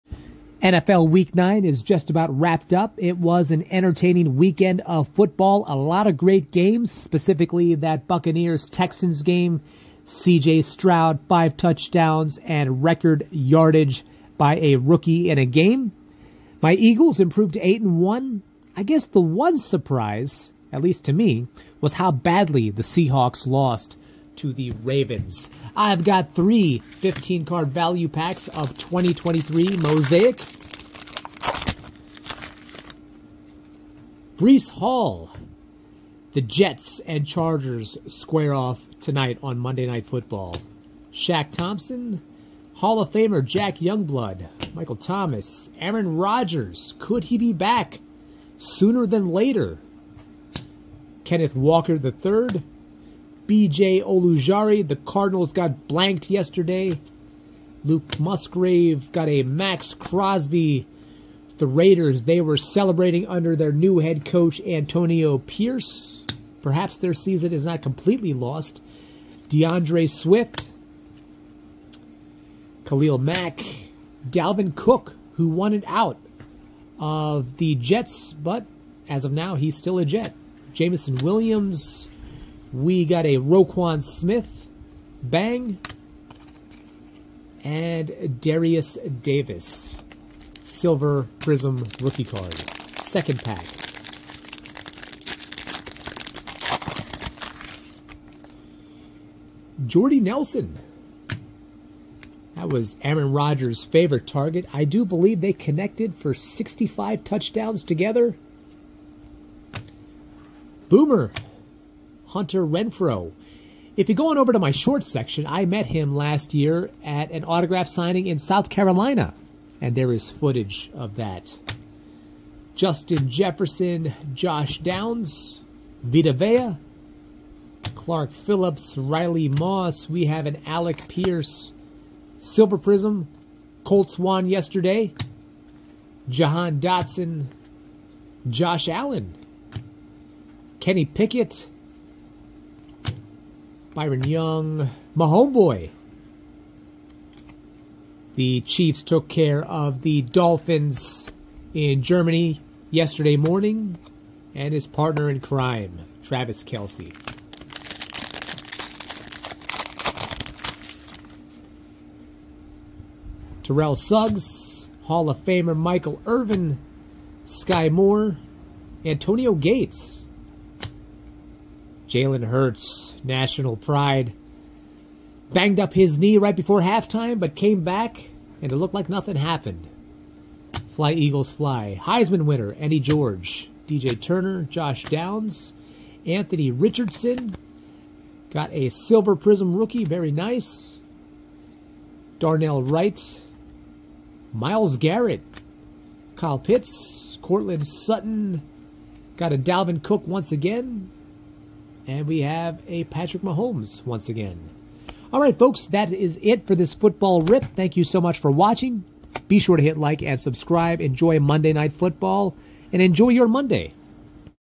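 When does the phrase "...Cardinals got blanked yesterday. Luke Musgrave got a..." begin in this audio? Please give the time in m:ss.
0:54.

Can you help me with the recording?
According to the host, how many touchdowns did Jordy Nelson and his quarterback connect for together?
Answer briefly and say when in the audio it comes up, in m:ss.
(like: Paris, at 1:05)
65, at 1:46.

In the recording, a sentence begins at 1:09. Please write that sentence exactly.
D'Andre Swift, Khalil Mack, Dalvin Cook, who wanted out of the Jets, but as of now, he's still a Jet.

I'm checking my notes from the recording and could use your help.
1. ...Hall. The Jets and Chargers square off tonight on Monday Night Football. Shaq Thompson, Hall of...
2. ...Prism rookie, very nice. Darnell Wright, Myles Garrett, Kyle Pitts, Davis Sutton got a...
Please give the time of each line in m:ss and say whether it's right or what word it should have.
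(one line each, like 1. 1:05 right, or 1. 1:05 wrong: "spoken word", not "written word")
1. 0:34 right
2. 3:09 wrong: "Courtland", not "Davis".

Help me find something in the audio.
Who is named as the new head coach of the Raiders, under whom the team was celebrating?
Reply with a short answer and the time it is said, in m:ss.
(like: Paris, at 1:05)
Antonio Pierce, at 1:04.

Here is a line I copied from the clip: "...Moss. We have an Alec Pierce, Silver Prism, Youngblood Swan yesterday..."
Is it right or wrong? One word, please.
wrong.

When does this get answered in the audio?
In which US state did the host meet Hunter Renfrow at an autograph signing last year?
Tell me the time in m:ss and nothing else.
1:58.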